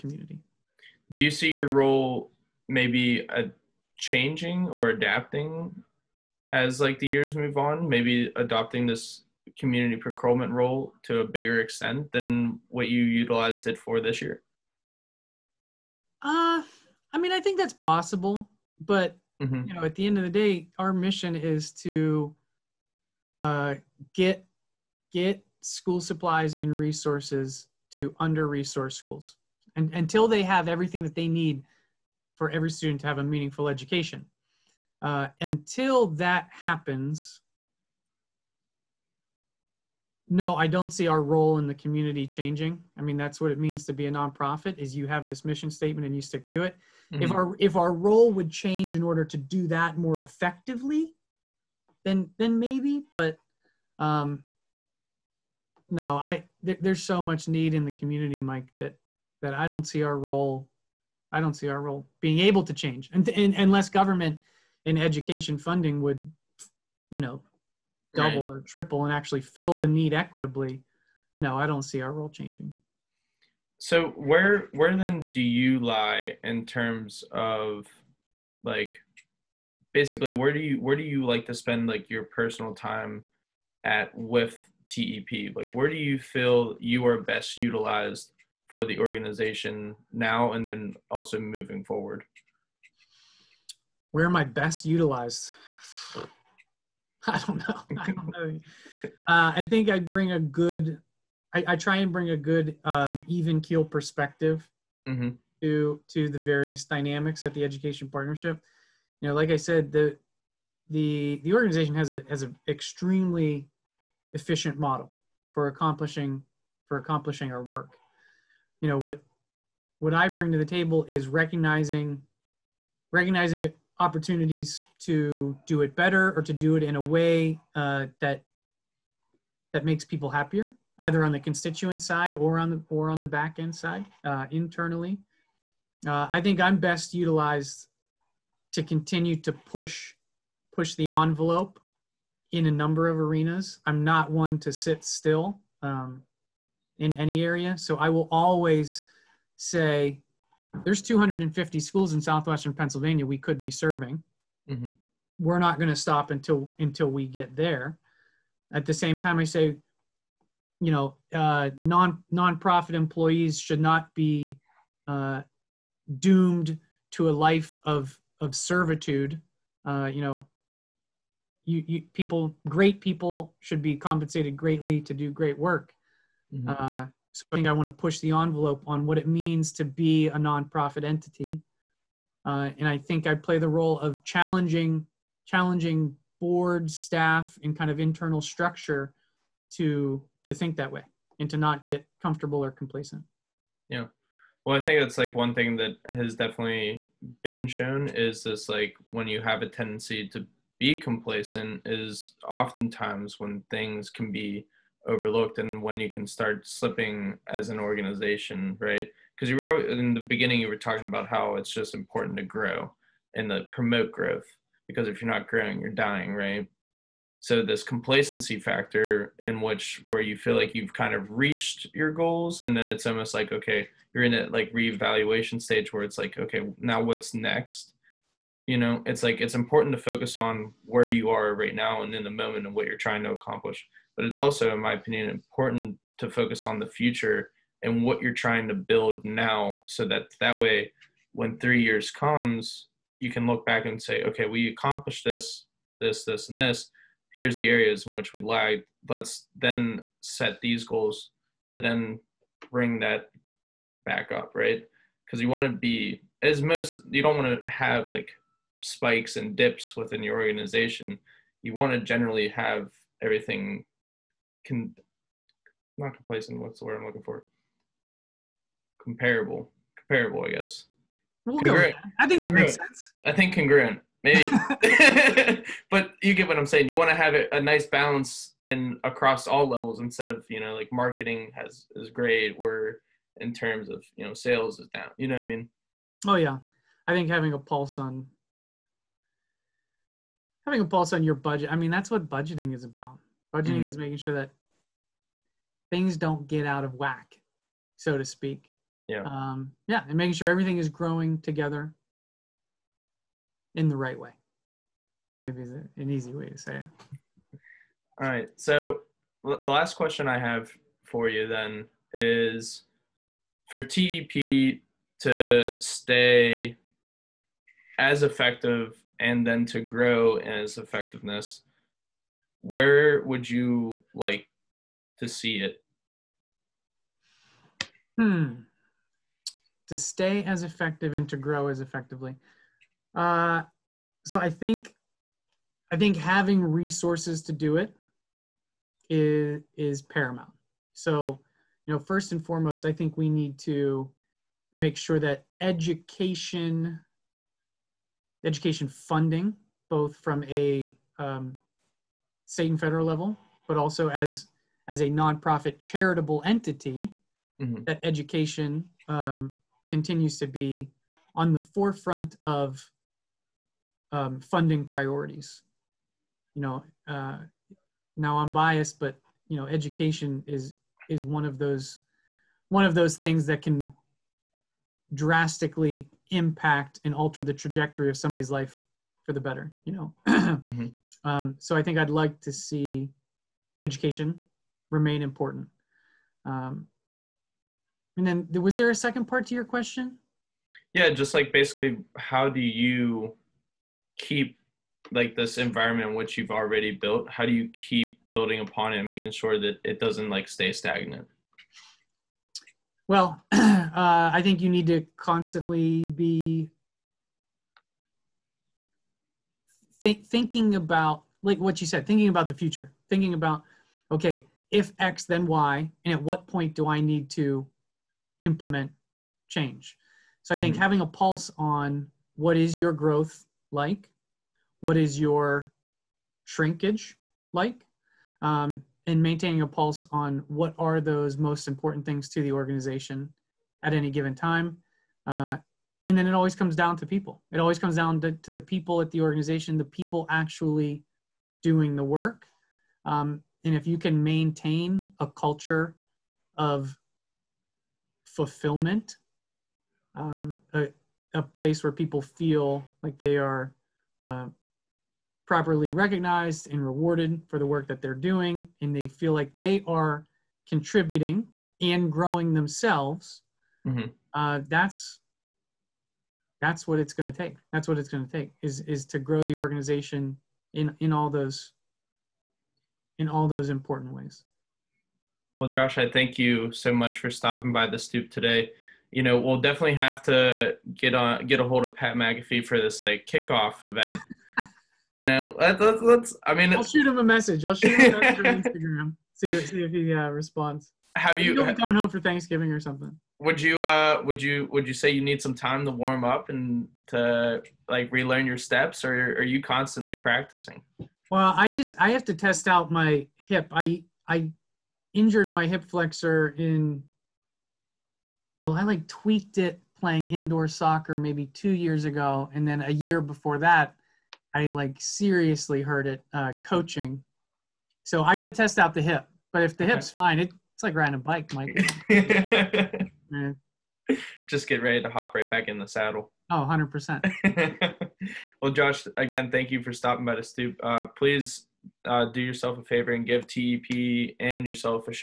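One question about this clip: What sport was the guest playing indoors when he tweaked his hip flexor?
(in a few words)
soccer.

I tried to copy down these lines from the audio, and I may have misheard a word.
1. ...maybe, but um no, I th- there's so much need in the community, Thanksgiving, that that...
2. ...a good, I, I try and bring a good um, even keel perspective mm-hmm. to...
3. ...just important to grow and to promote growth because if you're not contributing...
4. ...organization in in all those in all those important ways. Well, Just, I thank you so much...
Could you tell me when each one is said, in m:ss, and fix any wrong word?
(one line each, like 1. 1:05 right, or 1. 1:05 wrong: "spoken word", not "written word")
1. 0:52 wrong: "Mike", not "Thanksgiving"
2. 1:40 right
3. 3:31 wrong: "growing", not "contributing"
4. 7:49 wrong: "Josh", not "Just".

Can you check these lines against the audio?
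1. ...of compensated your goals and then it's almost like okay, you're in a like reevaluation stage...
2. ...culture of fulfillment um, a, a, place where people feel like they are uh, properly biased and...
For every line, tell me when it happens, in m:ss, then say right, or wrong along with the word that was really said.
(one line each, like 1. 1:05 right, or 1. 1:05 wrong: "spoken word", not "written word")
1. 3:41 wrong: "reached", not "compensated"
2. 7:25 wrong: "recognized", not "biased".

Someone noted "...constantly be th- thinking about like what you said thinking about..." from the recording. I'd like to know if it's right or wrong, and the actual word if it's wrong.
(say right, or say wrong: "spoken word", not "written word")
right.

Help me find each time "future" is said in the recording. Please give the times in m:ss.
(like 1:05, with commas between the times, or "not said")
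3:56, 6:52.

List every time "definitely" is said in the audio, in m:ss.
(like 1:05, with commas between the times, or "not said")
3:16, 7:59.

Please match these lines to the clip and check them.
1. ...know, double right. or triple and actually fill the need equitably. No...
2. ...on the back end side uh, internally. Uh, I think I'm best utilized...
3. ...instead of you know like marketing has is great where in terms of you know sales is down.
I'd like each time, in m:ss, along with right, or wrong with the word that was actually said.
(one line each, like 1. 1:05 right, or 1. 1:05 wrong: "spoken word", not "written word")
1. 1:07 right
2. 2:13 right
3. 4:39 right.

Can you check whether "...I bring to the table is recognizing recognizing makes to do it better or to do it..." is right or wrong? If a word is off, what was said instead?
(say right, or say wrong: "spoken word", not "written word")
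wrong: "opportunities", not "makes".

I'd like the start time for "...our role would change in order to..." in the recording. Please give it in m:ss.
0:47.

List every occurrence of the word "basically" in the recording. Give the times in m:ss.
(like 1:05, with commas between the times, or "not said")
1:19, 6:31.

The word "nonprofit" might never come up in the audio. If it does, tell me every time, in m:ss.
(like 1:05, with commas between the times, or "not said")
0:44, 2:42, 3:00, 5:55.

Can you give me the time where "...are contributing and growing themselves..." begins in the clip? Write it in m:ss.
7:39.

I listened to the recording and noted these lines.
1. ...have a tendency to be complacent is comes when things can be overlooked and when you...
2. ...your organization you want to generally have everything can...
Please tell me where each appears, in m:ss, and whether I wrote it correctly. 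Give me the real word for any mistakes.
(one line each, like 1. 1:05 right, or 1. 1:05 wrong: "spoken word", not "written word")
1. 3:19 wrong: "oftentimes", not "comes"
2. 4:20 right.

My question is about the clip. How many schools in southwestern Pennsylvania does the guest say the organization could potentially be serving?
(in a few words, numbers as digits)
250.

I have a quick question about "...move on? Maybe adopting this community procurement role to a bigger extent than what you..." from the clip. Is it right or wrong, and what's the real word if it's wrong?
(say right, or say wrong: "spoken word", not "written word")
right.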